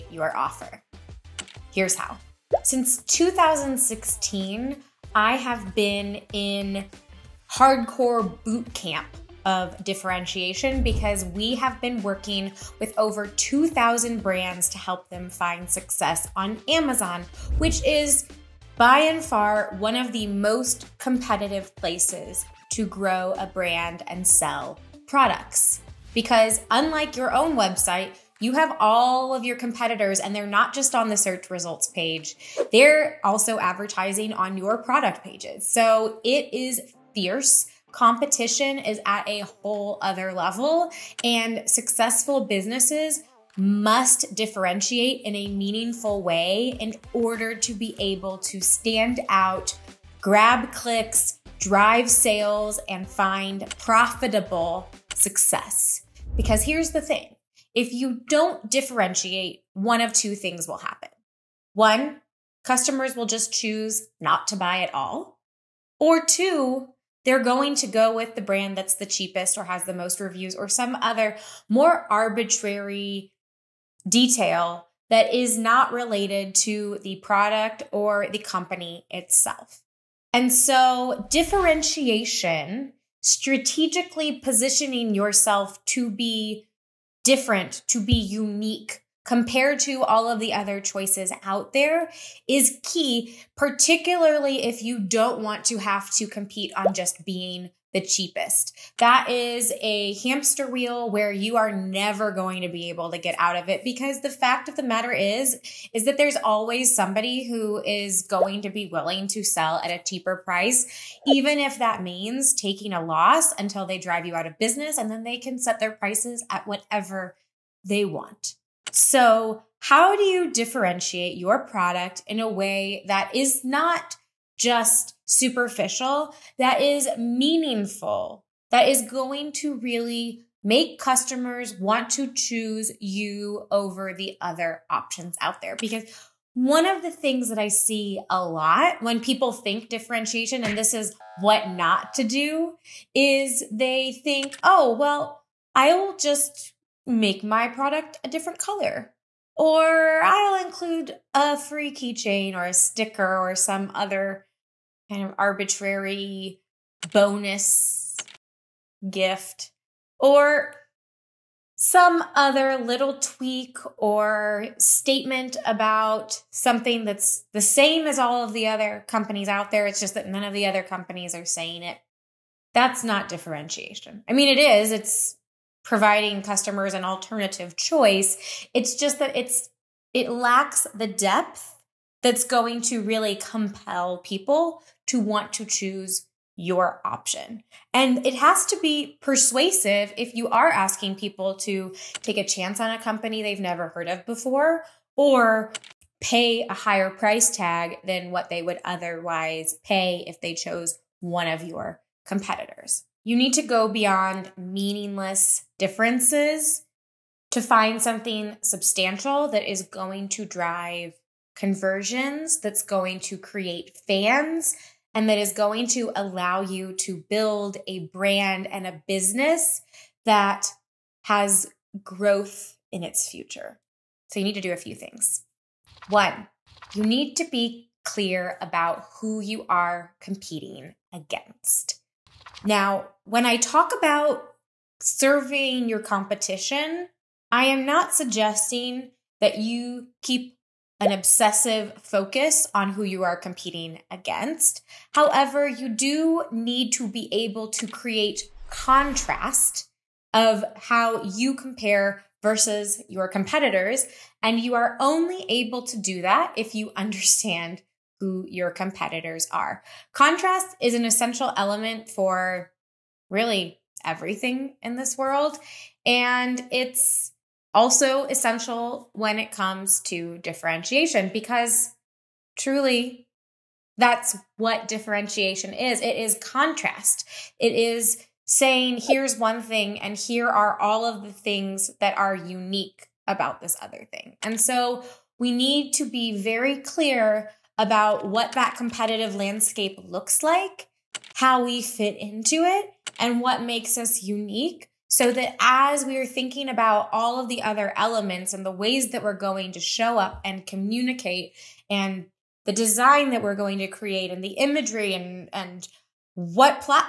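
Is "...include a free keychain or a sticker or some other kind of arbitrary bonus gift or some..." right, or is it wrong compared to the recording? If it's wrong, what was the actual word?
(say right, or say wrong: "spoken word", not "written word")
right.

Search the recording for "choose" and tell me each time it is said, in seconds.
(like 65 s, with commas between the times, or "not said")
63 s, 132 s, 185 s.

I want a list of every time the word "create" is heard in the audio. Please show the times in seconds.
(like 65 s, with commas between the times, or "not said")
213 s, 247 s, 303 s.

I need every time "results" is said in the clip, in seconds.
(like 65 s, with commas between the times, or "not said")
31 s.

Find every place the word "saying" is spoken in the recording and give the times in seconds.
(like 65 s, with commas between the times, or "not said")
171 s, 278 s.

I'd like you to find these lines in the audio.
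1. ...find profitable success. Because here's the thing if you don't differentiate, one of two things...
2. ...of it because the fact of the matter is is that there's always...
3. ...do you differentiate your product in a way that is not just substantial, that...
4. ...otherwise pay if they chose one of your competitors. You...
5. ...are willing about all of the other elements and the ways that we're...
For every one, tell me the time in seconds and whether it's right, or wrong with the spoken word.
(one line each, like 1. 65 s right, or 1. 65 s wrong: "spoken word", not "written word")
1. 53 s right
2. 103 s right
3. 120 s wrong: "superficial", not "substantial"
4. 198 s right
5. 296 s wrong: "thinking", not "willing".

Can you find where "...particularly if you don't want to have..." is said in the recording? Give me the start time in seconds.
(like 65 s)
93 s.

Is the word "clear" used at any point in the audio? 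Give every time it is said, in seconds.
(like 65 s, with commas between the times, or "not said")
228 s, 286 s.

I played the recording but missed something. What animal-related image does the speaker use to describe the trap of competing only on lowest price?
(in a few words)
hamster wheel.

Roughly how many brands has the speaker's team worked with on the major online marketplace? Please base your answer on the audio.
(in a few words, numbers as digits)
over 2,000.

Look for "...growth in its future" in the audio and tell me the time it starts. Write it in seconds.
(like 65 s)
222 s.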